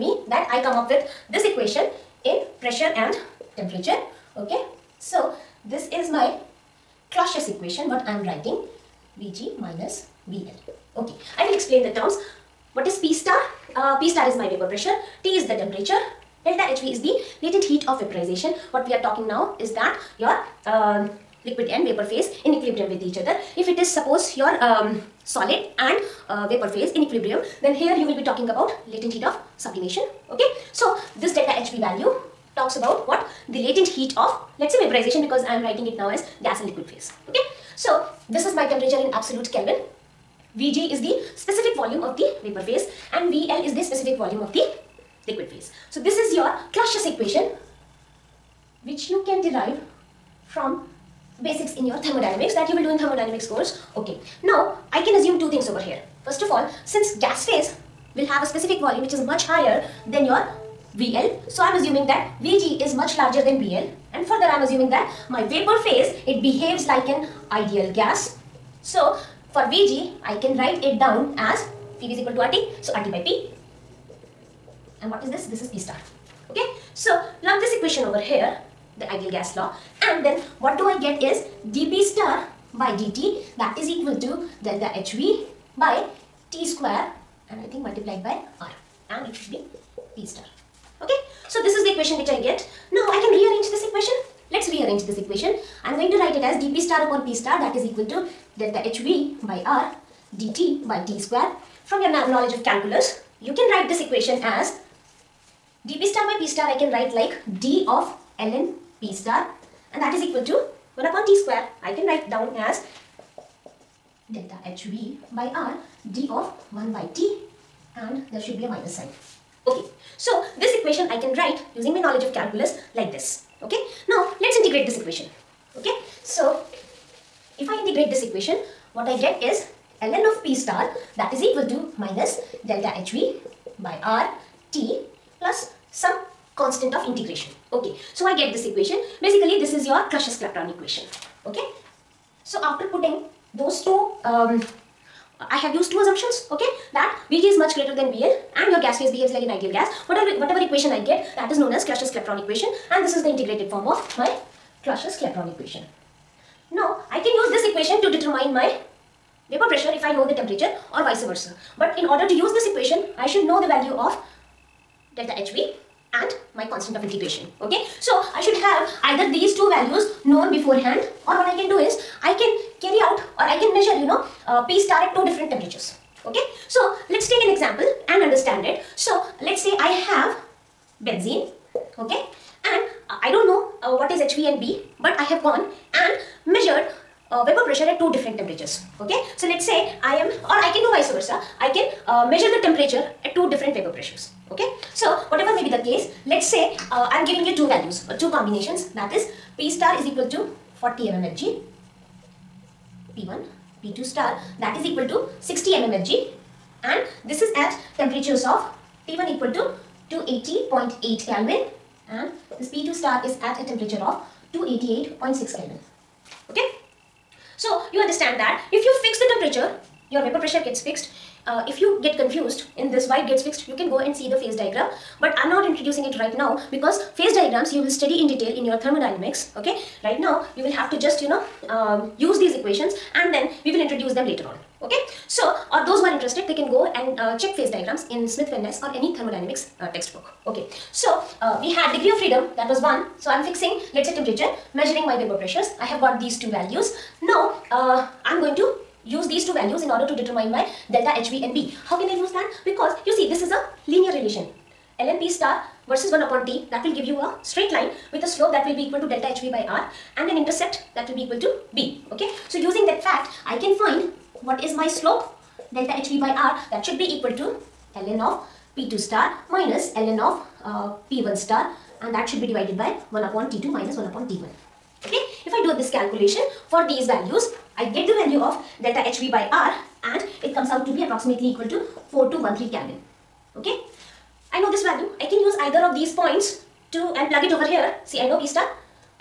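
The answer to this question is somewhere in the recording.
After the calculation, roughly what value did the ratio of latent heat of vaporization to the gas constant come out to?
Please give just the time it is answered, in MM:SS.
04:42.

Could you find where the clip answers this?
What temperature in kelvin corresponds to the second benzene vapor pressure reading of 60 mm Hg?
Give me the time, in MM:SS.
03:34.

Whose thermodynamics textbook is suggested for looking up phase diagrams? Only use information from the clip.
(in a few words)
Smith-Van.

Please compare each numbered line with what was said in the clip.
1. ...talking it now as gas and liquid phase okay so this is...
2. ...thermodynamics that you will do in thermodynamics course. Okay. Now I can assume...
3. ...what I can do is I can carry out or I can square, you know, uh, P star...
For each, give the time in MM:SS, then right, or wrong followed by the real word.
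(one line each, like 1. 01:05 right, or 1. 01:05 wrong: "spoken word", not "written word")
1. 00:35 wrong: "writing", not "talking"
2. 00:51 right
3. 02:51 wrong: "measure", not "square".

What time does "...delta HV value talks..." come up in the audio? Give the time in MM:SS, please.
00:31.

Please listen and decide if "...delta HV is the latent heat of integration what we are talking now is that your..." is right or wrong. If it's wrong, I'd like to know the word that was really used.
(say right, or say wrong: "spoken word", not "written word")
wrong: "vaporization", not "integration".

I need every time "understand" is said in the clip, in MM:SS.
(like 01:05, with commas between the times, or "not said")
02:58, 03:37.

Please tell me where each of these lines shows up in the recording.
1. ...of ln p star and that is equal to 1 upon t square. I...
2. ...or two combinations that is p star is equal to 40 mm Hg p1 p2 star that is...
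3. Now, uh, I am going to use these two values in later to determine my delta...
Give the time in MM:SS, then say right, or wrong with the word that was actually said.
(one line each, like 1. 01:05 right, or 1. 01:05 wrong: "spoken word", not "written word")
1. 01:47 right
2. 03:18 right
3. 04:07 wrong: "order", not "later".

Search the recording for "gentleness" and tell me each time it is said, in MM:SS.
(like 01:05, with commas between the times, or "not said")
not said.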